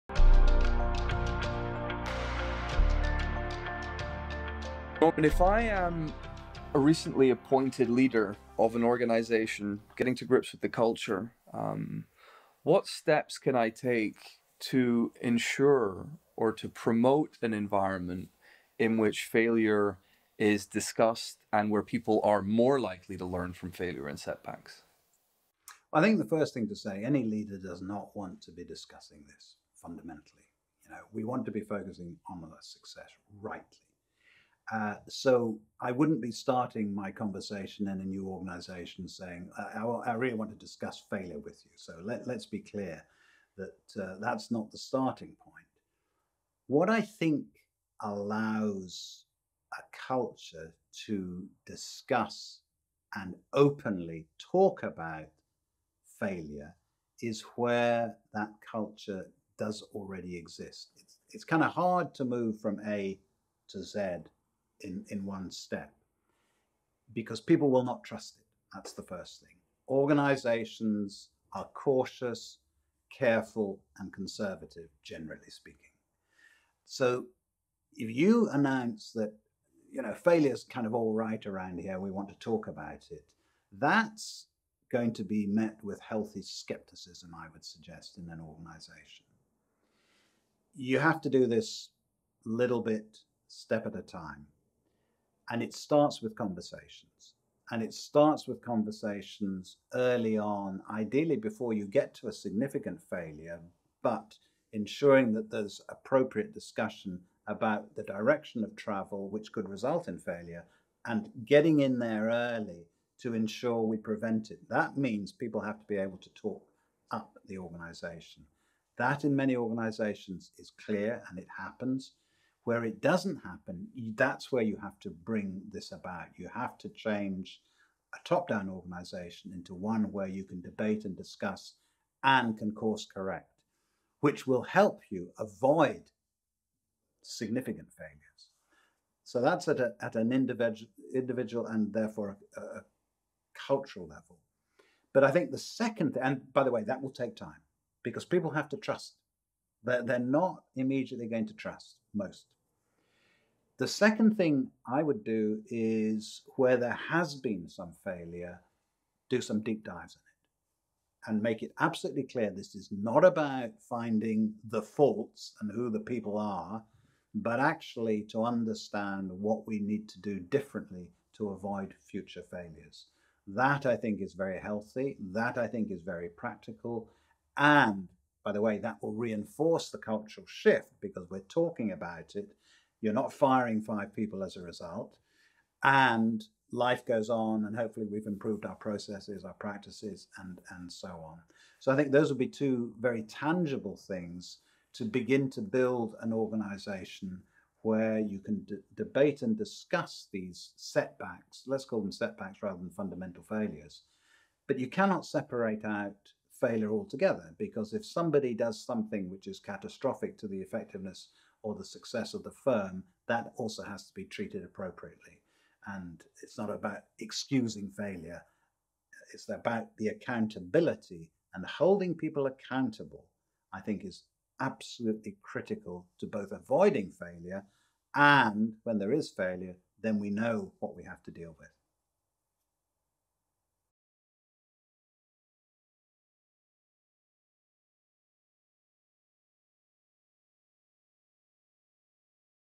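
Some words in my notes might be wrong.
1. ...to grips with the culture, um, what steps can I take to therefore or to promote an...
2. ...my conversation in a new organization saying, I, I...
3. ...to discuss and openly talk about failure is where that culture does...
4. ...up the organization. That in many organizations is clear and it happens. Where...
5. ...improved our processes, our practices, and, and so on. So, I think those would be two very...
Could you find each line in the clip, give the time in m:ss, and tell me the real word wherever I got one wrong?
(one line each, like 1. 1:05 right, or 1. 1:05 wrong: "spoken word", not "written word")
1. 0:10 wrong: "ensure", not "therefore"
2. 0:36 right
3. 0:51 right
4. 1:57 right
5. 3:08 right.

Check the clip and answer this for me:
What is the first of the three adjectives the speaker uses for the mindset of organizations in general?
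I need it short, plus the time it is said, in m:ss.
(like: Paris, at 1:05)
cautious, at 1:11.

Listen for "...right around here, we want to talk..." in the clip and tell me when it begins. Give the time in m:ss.
1:21.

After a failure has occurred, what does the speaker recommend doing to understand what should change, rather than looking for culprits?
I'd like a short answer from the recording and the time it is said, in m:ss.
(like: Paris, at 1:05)
deep dives, at 2:39.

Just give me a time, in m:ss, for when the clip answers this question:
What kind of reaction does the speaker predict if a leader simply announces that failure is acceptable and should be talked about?
1:25.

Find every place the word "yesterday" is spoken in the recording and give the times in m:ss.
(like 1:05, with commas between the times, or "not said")
not said.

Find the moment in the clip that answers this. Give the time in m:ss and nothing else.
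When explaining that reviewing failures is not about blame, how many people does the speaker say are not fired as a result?
3:03.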